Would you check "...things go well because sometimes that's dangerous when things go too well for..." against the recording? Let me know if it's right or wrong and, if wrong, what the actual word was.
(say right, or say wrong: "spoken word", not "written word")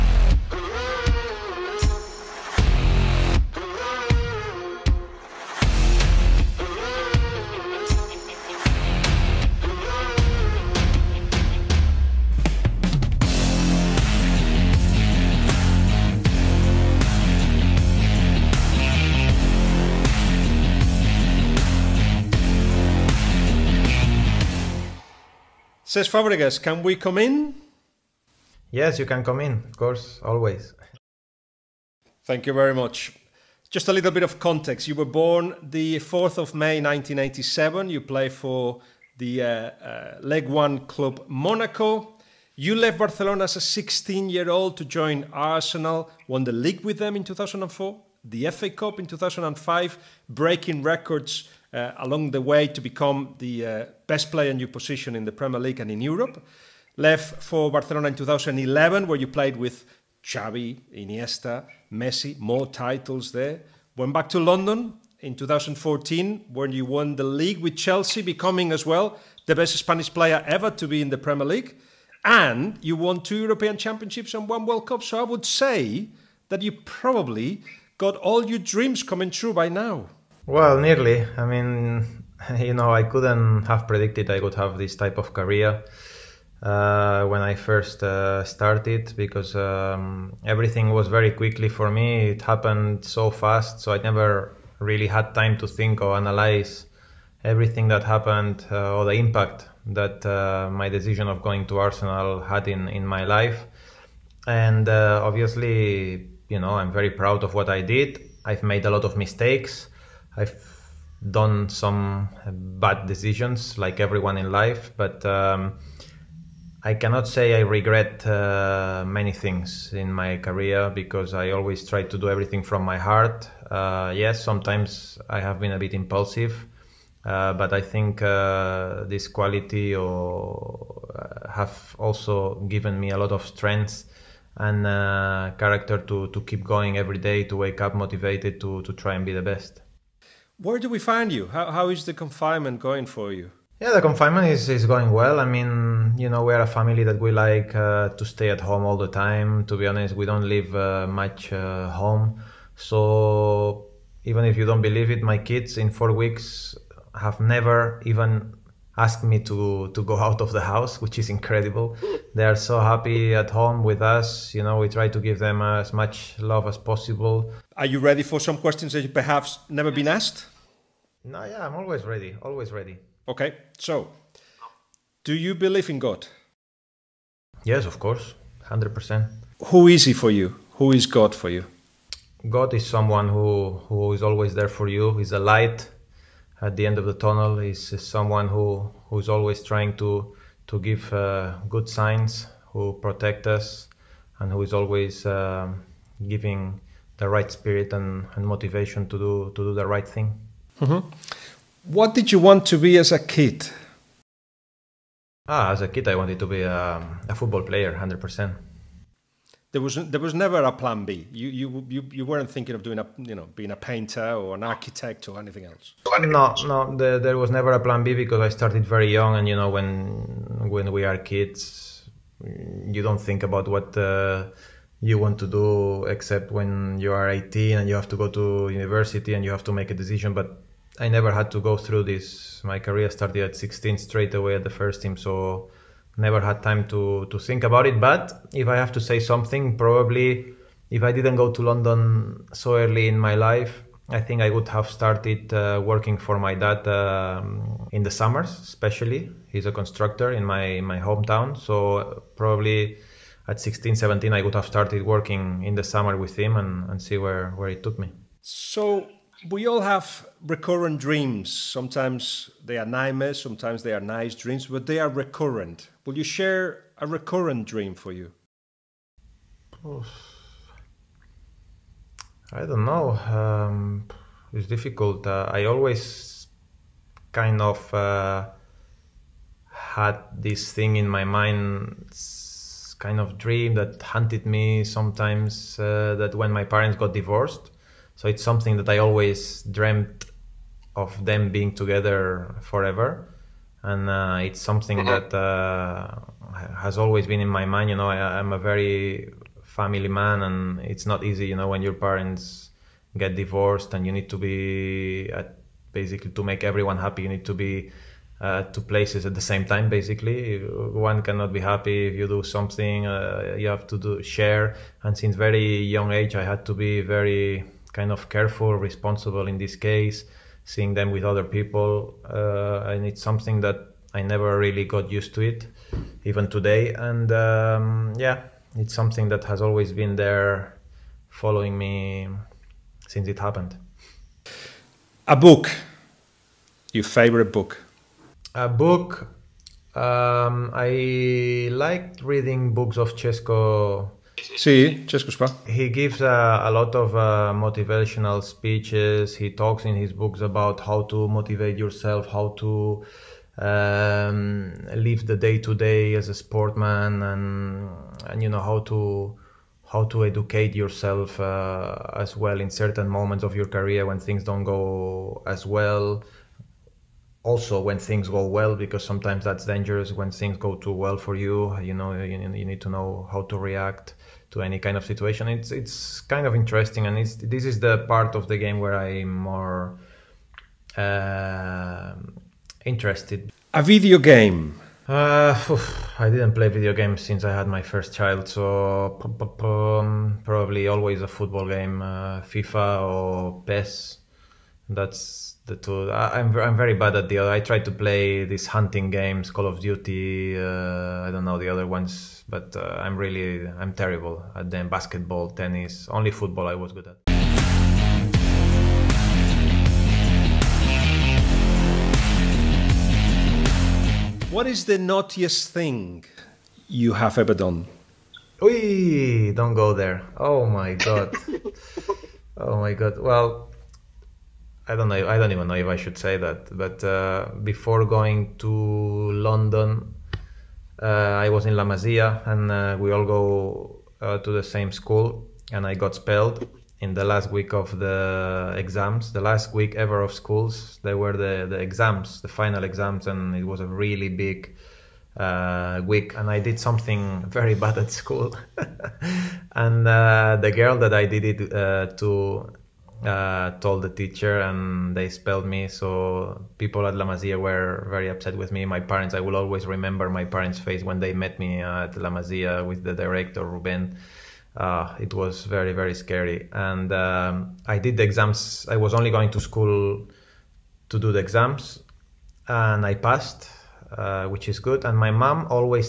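right.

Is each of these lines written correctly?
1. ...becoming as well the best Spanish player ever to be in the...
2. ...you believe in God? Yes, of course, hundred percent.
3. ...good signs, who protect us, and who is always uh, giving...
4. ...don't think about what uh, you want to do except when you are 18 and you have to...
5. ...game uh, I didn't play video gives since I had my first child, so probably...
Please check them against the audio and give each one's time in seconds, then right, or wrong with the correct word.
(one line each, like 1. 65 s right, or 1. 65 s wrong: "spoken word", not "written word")
1. 68 s right
2. 175 s right
3. 191 s right
4. 223 s right
5. 384 s wrong: "games", not "gives".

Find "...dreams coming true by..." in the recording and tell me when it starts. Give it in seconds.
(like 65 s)
78 s.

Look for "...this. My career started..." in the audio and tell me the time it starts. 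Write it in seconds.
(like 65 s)
232 s.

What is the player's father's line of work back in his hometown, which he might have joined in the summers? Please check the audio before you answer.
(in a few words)
Constructor.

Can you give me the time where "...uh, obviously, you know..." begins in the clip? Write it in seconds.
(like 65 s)
104 s.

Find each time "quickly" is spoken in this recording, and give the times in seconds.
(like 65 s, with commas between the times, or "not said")
91 s.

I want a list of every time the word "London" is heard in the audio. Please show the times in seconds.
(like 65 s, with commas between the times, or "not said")
64 s, 241 s, 428 s.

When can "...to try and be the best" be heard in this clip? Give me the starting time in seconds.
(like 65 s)
138 s.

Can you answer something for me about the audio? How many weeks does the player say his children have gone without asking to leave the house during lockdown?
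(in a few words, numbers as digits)
4.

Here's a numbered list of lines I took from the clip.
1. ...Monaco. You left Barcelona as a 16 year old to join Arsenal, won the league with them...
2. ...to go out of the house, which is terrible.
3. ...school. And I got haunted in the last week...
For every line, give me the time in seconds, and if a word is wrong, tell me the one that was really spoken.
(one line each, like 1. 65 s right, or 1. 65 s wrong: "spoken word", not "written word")
1. 41 s right
2. 159 s wrong: "incredible", not "terrible"
3. 434 s wrong: "expelled", not "haunted".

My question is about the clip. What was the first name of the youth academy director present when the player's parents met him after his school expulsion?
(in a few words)
Ruben.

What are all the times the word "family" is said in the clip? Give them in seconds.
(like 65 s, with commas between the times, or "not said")
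146 s, 299 s.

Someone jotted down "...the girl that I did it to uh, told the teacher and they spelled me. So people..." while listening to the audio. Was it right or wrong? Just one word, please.
right.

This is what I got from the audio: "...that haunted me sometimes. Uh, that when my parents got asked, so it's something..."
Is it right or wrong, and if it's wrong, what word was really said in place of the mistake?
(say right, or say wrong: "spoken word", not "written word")
wrong: "divorced", not "asked".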